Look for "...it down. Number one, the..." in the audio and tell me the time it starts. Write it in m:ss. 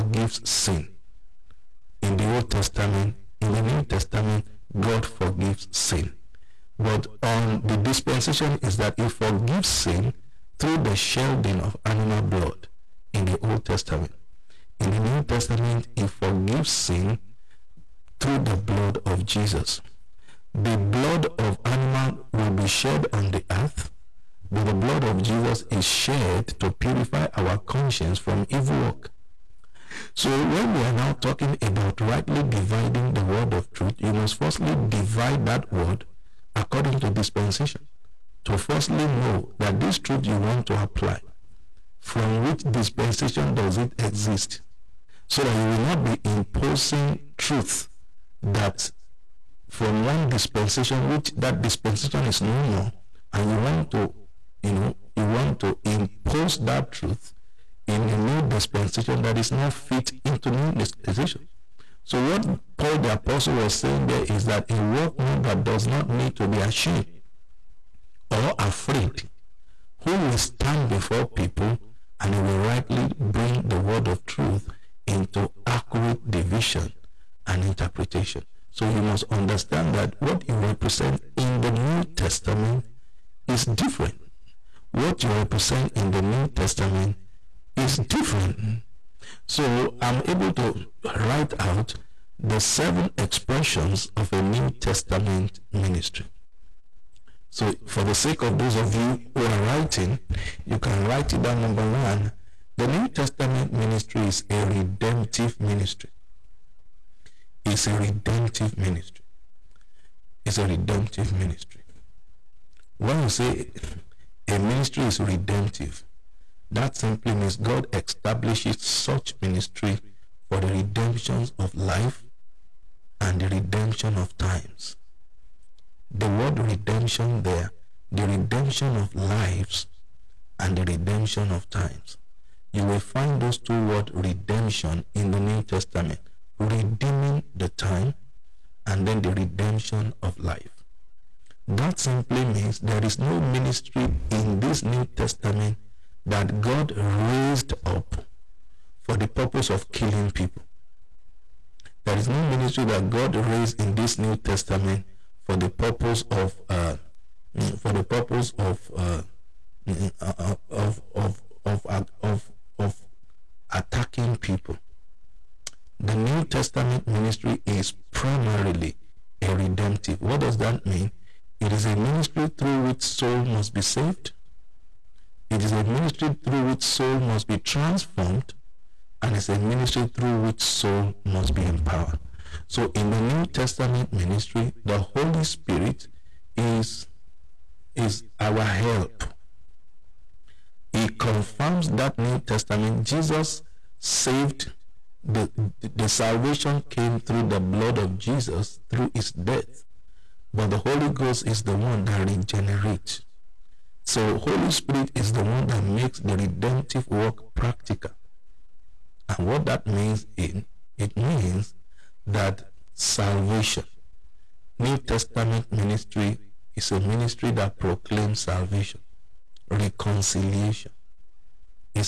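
1:41.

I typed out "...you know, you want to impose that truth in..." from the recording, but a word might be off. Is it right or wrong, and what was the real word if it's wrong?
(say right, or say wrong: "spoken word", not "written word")
right.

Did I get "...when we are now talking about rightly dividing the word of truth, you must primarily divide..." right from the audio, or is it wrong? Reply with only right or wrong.
wrong.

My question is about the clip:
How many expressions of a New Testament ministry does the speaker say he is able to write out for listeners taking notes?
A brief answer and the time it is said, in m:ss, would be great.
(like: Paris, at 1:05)
7, at 1:32.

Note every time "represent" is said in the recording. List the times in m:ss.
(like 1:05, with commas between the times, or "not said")
1:20, 1:25.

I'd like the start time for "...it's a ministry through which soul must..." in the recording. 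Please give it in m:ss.
2:59.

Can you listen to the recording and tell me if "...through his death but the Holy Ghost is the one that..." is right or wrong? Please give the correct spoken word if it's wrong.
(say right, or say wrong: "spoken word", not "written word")
right.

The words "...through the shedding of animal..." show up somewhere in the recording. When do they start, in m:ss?
0:10.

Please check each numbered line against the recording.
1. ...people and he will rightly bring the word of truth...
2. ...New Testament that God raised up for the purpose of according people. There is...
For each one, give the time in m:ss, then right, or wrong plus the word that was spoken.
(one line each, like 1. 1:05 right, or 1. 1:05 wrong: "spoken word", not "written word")
1. 1:11 right
2. 2:24 wrong: "killing", not "according".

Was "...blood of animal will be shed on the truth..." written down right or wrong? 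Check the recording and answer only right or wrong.
wrong.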